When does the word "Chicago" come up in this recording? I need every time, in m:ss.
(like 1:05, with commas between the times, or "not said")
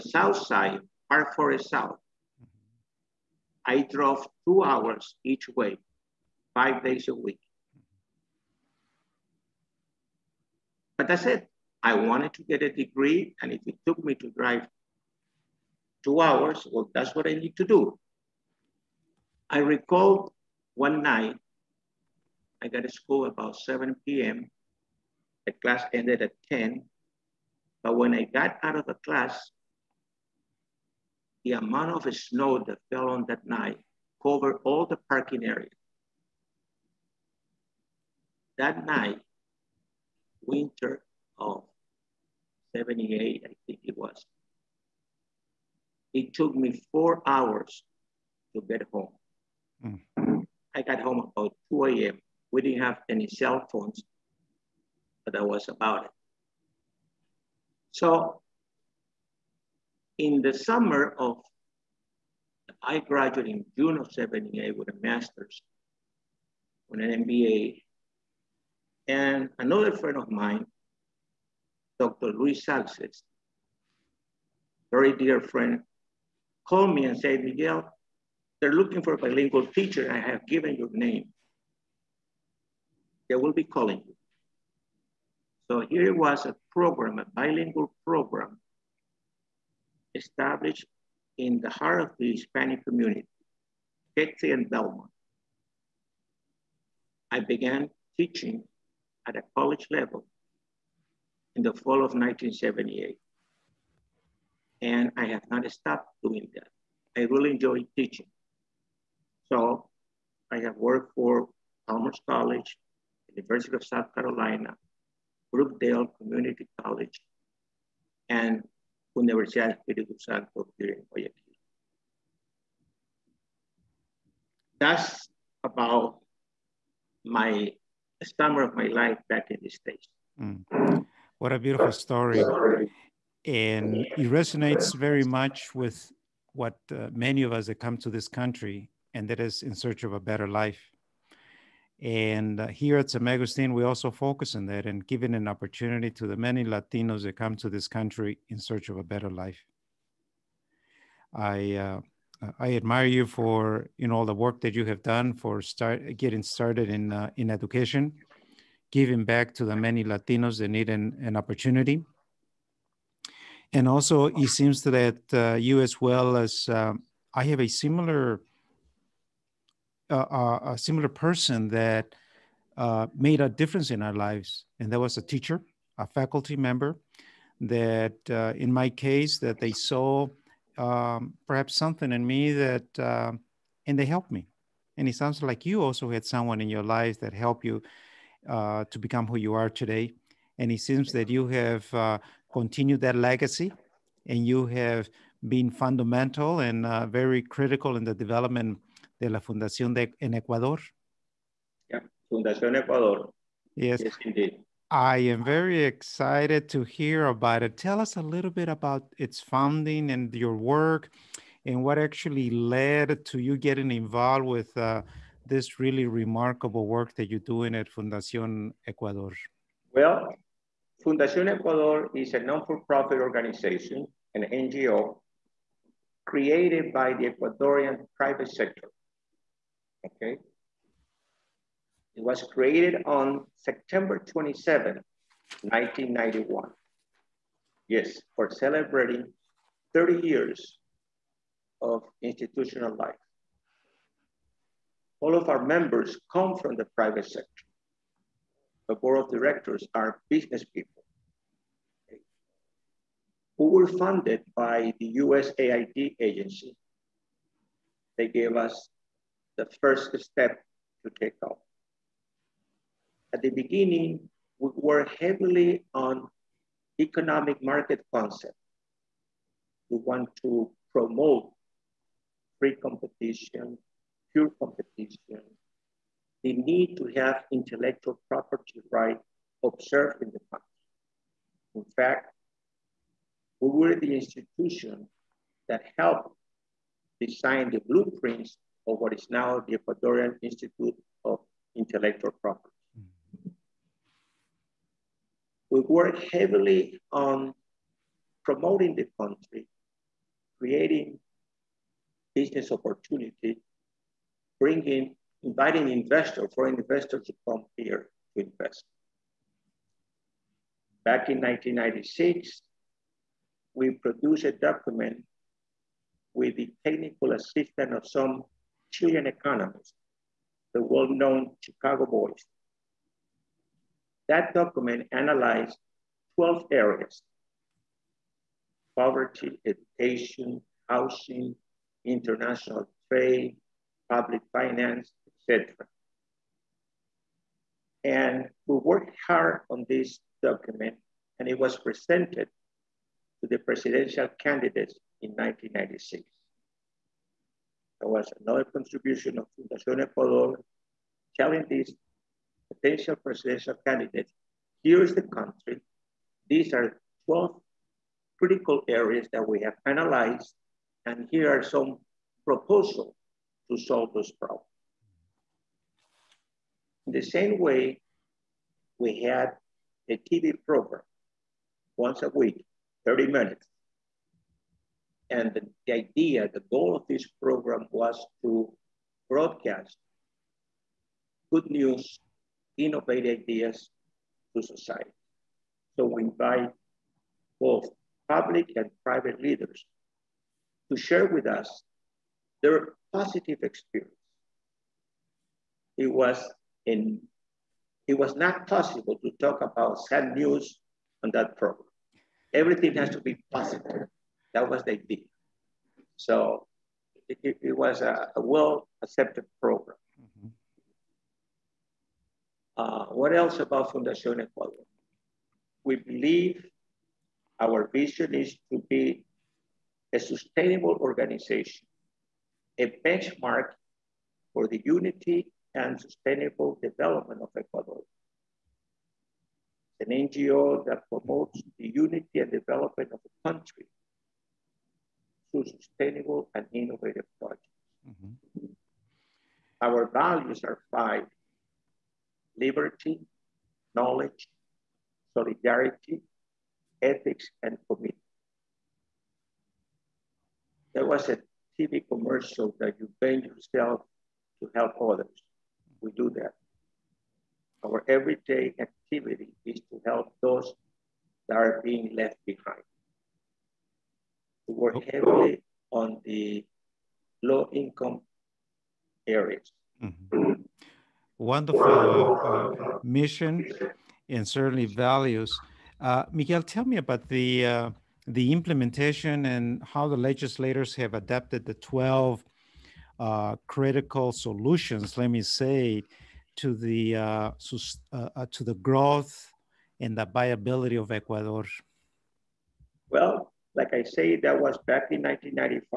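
5:21.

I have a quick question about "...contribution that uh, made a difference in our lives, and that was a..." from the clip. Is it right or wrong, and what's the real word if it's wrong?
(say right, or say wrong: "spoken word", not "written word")
wrong: "person", not "contribution".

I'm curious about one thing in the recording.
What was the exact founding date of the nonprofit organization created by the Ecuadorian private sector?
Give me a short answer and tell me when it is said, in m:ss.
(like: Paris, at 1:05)
September 27, 1991, at 3:53.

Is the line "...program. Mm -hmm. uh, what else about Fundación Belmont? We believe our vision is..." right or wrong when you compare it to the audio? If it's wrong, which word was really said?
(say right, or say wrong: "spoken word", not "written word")
wrong: "Ecuador", not "Belmont".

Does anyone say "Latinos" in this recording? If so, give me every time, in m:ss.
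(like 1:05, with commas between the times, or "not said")
2:26, 2:40.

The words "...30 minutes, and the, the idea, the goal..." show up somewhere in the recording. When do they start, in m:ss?
6:13.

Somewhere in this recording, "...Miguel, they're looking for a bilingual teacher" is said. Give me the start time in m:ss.
1:17.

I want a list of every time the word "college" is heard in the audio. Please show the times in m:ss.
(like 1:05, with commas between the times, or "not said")
1:39, 1:52, 1:56.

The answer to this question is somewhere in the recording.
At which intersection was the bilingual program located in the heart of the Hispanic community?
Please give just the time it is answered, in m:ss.
1:34.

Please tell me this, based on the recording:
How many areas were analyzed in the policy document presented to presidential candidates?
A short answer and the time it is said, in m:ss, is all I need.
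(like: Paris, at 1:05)
12, at 5:26.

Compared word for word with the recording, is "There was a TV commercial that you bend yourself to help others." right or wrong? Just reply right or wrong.
right.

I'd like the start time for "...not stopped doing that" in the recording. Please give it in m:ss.
1:45.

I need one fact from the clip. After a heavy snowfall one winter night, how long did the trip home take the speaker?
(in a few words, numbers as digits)
4 hours.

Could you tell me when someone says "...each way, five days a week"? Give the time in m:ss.
0:05.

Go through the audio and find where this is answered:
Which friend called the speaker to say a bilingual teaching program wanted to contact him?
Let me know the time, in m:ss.
1:11.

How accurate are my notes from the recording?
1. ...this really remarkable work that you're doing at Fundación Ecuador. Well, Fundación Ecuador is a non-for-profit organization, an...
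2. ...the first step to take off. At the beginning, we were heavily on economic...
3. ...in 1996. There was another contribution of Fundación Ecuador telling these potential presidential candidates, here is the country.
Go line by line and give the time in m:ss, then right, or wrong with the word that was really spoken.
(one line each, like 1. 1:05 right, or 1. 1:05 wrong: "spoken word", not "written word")
1. 3:35 right
2. 4:19 right
3. 5:45 right.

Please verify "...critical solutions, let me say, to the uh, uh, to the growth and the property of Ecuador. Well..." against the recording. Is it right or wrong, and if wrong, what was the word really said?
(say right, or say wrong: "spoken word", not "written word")
wrong: "viability", not "property".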